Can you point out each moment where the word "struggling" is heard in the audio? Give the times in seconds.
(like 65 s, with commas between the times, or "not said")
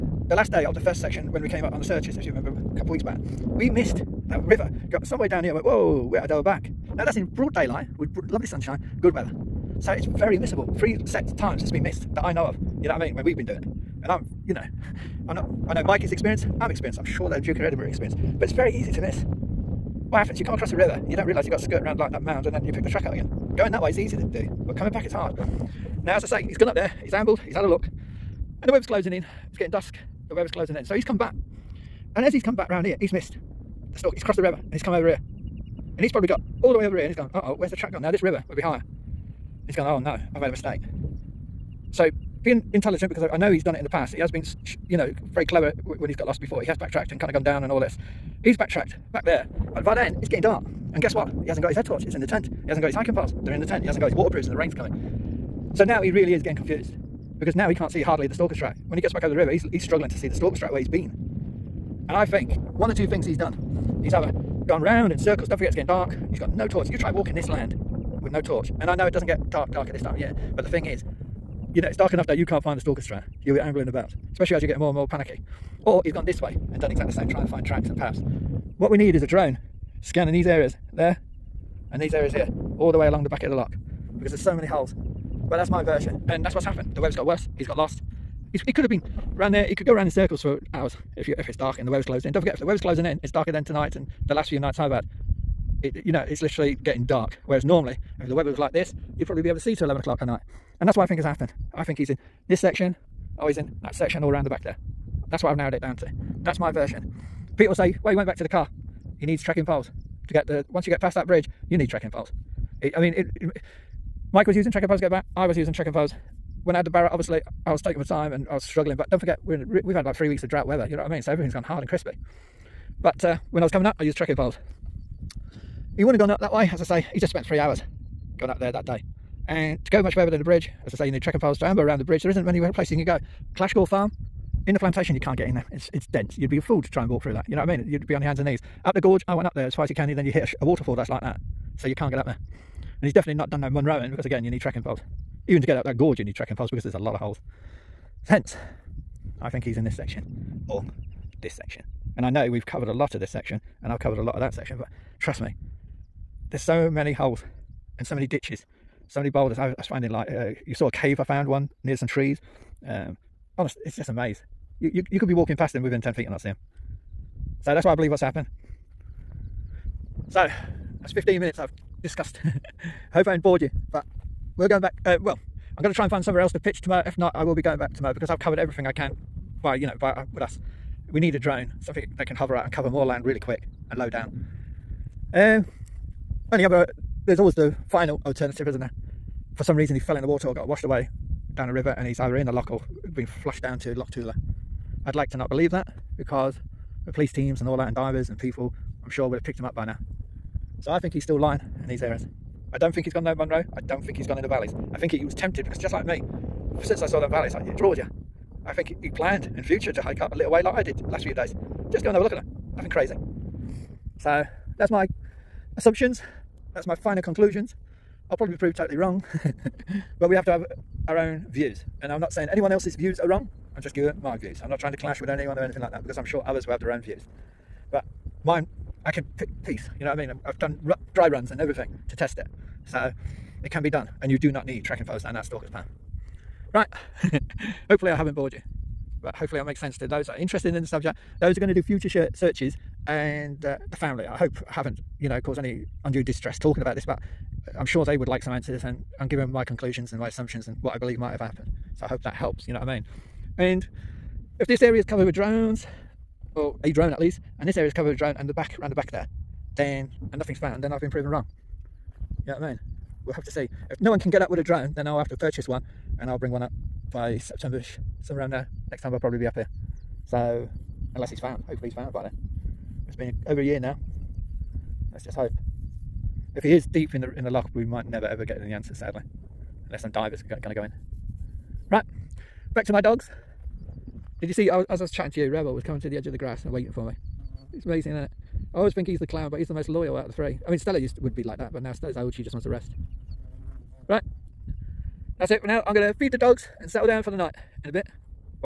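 59 s, 118 s.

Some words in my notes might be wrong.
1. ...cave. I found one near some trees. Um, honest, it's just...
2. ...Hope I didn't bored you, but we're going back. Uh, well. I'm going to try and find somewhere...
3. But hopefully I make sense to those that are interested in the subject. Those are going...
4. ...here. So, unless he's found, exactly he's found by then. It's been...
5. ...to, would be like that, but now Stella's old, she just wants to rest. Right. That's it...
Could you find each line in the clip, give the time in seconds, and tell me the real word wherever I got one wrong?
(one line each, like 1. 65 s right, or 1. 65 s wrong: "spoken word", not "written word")
1. 160 s right
2. 173 s right
3. 239 s right
4. 269 s wrong: "hopefully", not "exactly"
5. 291 s right.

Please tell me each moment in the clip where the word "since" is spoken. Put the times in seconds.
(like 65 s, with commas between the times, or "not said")
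206 s.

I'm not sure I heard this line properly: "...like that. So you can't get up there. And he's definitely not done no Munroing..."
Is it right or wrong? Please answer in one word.
right.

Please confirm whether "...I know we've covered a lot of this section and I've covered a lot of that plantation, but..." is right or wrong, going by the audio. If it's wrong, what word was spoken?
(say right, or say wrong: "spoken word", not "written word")
wrong: "section", not "plantation".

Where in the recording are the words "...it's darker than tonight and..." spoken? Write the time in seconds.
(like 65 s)
93 s.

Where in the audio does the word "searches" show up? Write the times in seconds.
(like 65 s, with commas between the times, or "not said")
1 s, 242 s.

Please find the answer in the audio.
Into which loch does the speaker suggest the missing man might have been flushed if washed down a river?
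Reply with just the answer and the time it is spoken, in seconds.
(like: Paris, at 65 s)
Loch Tulla, at 193 s.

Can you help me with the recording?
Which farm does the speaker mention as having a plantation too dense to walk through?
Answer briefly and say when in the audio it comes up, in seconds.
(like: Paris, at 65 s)
Clashgour Farm, at 133 s.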